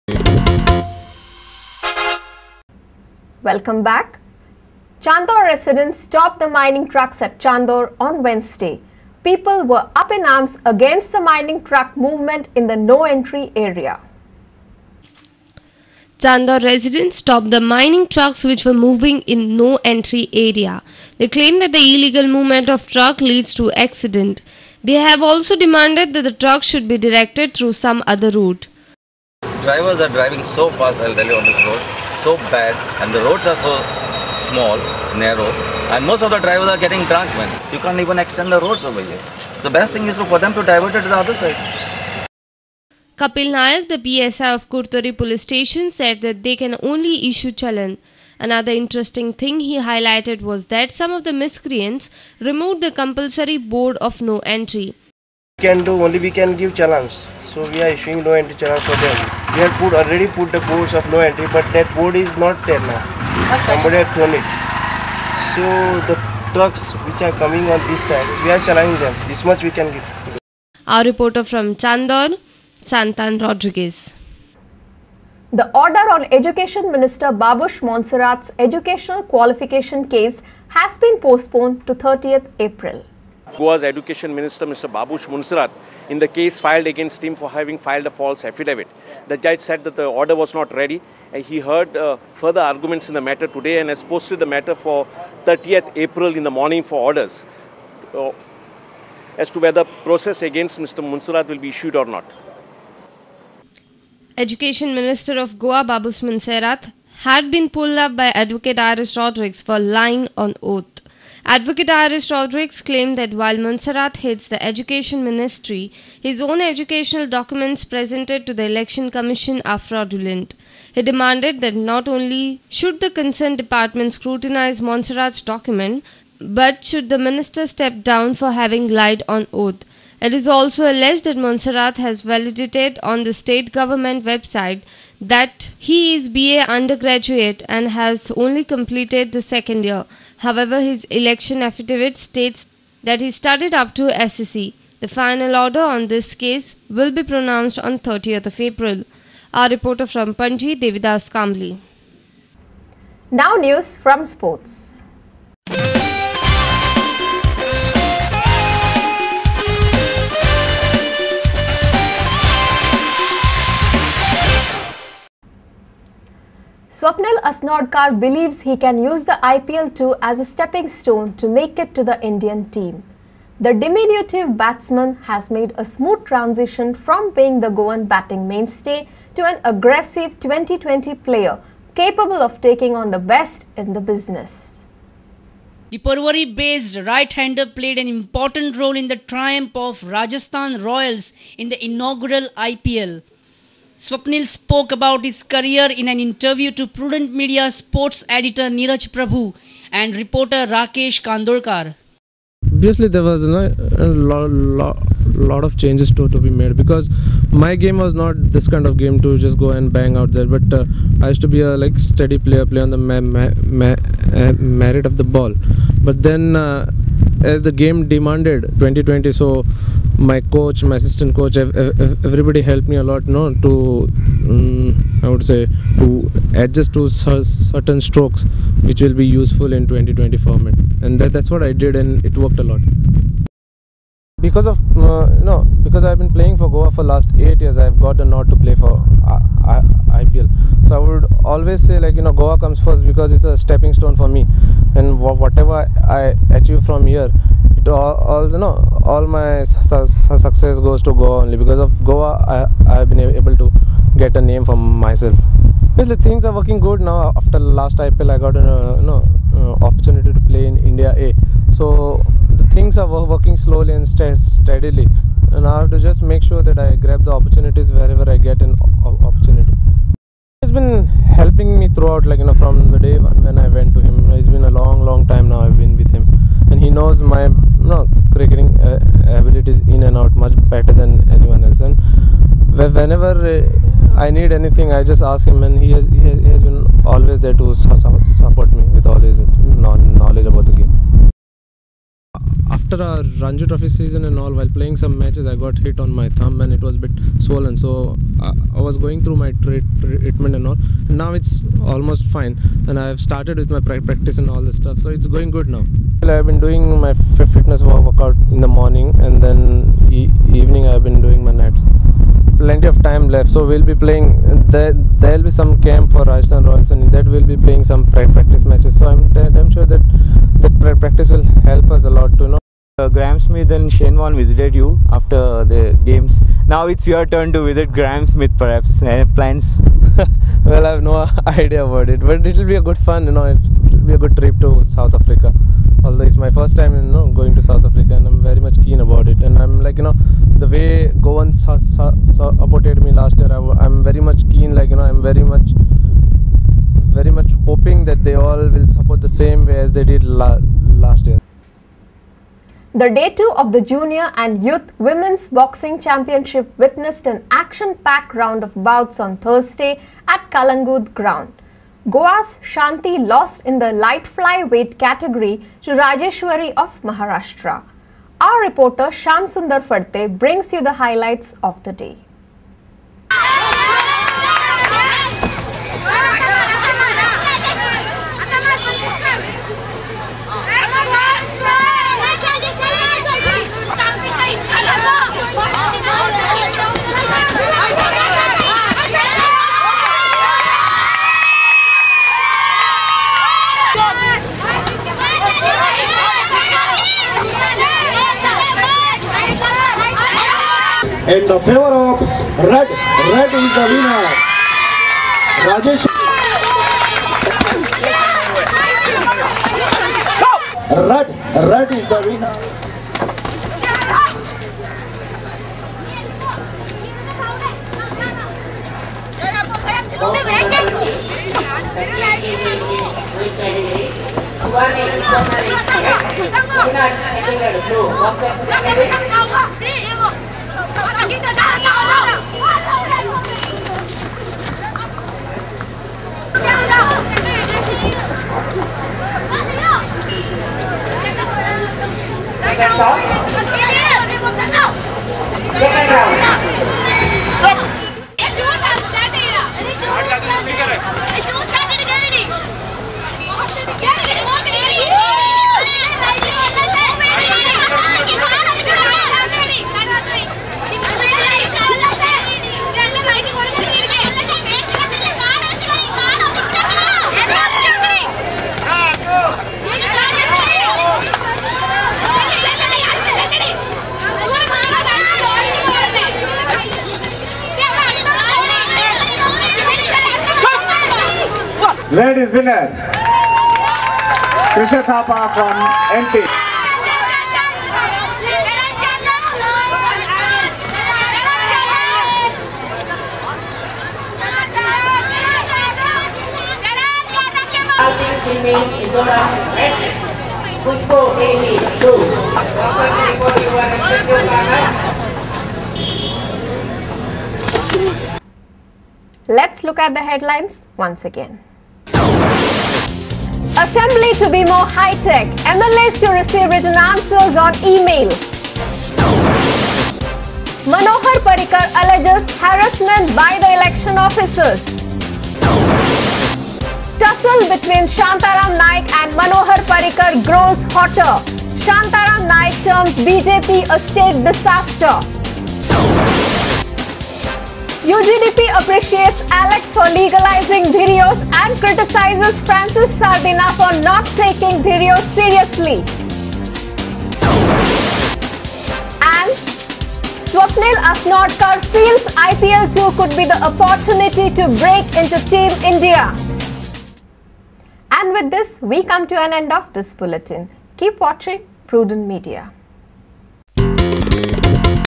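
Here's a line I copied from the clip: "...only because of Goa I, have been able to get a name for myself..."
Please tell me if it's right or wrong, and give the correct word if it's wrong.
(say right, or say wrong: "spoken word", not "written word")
right.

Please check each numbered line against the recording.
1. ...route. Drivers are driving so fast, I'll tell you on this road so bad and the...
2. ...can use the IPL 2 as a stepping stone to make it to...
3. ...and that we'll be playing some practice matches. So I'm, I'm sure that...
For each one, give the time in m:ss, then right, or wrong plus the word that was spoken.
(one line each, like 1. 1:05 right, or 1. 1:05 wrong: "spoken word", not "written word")
1. 0:28 right
2. 2:48 right
3. 5:16 right.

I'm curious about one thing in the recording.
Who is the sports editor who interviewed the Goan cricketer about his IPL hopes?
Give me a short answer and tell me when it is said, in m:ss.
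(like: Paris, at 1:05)
Neeraj Prabhu, at 3:18.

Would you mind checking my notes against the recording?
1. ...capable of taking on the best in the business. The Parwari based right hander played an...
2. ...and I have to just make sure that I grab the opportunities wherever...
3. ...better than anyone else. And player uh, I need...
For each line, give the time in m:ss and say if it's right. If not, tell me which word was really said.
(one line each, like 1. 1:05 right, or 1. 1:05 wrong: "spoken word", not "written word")
1. 3:01 right
2. 4:25 right
3. 4:40 wrong: "whenever", not "player".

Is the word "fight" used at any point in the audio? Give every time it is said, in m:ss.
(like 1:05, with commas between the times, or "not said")
not said.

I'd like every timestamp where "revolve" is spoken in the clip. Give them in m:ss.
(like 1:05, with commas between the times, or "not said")
not said.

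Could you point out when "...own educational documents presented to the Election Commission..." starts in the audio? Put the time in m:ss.
1:56.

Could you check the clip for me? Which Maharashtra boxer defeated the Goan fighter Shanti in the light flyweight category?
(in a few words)
Rajeshwari.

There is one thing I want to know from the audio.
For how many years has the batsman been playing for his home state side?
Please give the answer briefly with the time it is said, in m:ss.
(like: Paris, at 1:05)
8, at 3:57.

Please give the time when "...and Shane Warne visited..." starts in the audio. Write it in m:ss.
5:23.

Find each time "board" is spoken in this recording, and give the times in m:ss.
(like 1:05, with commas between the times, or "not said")
0:53, 1:01.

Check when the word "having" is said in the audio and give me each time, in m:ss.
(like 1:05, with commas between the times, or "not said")
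1:27, 2:08.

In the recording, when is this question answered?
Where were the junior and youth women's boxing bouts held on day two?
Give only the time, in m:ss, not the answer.
6:00.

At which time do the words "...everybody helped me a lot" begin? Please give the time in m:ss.
3:41.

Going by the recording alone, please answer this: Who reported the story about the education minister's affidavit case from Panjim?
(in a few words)
Devidas Kamli.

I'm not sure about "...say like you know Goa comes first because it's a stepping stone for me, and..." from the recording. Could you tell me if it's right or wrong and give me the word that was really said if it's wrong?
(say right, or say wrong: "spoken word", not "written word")
right.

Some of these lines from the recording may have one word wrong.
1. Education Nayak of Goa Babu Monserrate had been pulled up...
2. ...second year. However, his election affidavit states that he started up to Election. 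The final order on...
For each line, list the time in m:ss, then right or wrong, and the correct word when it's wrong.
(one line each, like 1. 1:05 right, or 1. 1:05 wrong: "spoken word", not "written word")
1. 1:44 wrong: "Minister", not "Nayak"
2. 2:19 wrong: "SEC", not "Election".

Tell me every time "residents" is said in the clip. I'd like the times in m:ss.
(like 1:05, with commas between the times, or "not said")
0:05, 0:16.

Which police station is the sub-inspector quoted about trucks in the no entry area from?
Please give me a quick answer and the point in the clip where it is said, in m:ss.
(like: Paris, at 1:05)
Kurtori, at 0:44.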